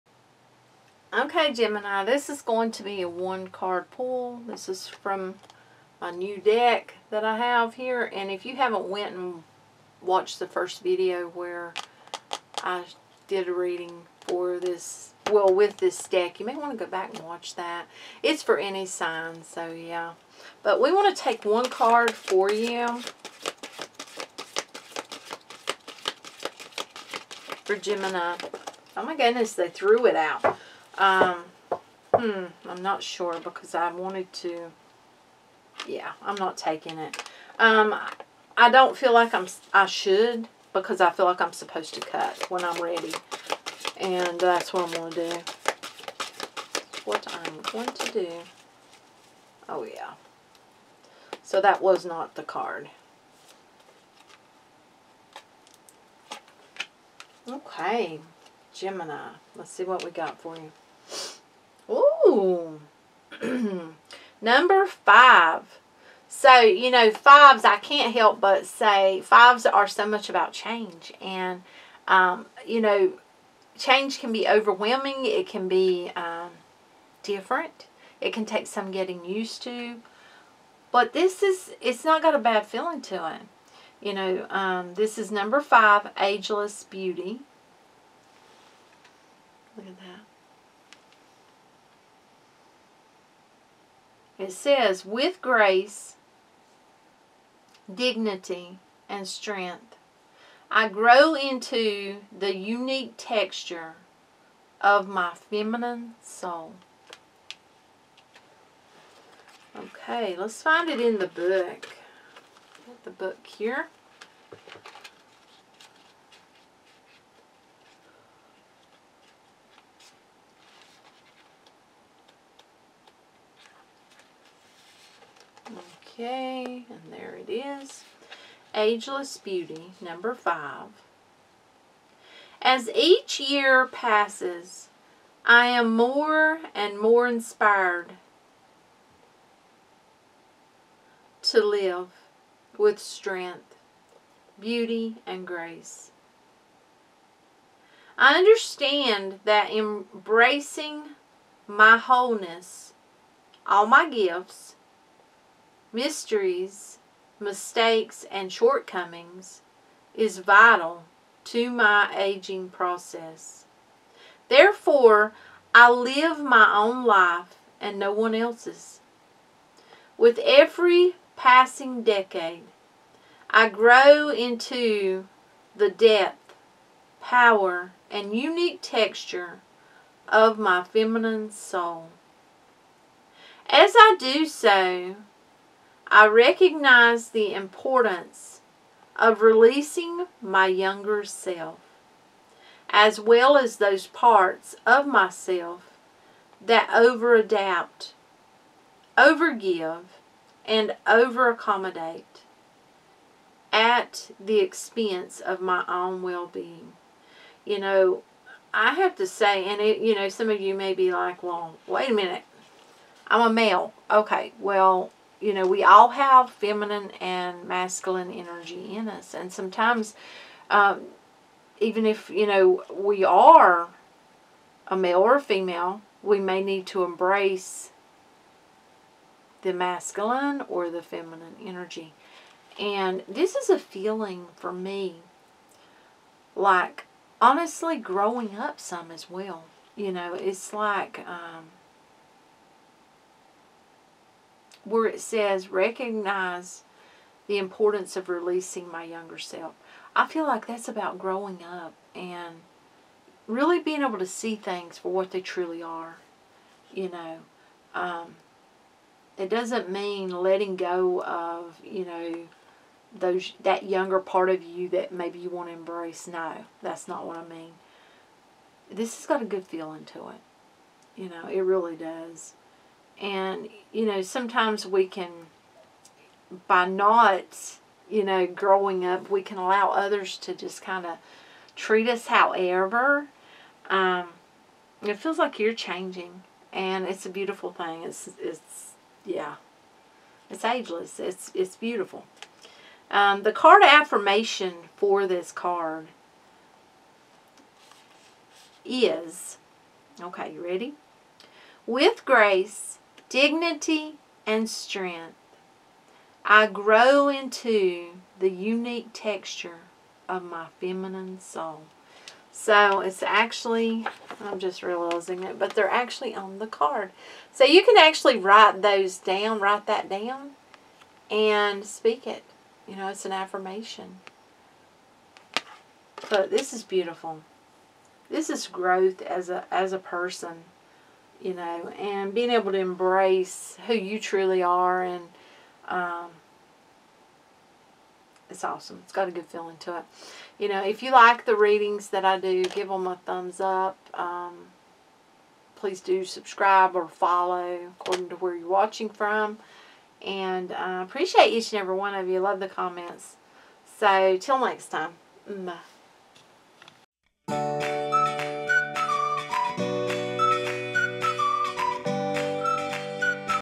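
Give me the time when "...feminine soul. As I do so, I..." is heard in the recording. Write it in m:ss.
3:00.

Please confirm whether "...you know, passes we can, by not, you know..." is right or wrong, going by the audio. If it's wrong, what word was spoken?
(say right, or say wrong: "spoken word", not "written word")
wrong: "sometimes", not "passes".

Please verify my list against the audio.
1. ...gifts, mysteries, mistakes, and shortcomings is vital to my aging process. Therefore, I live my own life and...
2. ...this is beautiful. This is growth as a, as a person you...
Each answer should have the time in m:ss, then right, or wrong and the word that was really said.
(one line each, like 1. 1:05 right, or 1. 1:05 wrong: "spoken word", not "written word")
1. 2:34 right
2. 5:26 right.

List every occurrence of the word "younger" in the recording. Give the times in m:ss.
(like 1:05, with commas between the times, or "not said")
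3:10, 4:09, 4:23.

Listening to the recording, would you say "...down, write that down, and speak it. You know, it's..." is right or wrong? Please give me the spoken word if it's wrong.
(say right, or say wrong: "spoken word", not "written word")
right.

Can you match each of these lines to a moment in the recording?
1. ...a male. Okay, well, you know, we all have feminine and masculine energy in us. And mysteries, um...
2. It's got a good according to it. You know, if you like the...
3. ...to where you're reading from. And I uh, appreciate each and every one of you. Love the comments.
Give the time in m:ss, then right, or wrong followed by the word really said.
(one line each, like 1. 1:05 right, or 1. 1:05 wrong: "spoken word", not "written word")
1. 3:33 wrong: "sometimes", not "mysteries"
2. 5:39 wrong: "feeling", not "according"
3. 5:48 wrong: "watching", not "reading".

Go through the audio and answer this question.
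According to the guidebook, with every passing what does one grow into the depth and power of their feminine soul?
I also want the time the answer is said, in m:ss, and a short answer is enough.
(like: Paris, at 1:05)
Decade, at 2:52.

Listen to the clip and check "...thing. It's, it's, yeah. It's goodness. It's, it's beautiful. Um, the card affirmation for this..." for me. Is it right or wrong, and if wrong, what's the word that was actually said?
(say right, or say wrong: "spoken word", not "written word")
wrong: "ageless", not "goodness".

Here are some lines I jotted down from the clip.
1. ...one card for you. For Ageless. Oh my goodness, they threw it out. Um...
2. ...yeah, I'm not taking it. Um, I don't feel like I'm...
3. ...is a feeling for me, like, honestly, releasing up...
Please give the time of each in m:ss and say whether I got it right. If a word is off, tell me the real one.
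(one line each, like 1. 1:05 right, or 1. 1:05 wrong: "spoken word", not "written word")
1. 0:21 wrong: "Gemini", not "Ageless"
2. 0:35 right
3. 3:53 wrong: "growing", not "releasing".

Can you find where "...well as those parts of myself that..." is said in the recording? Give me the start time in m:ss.
3:13.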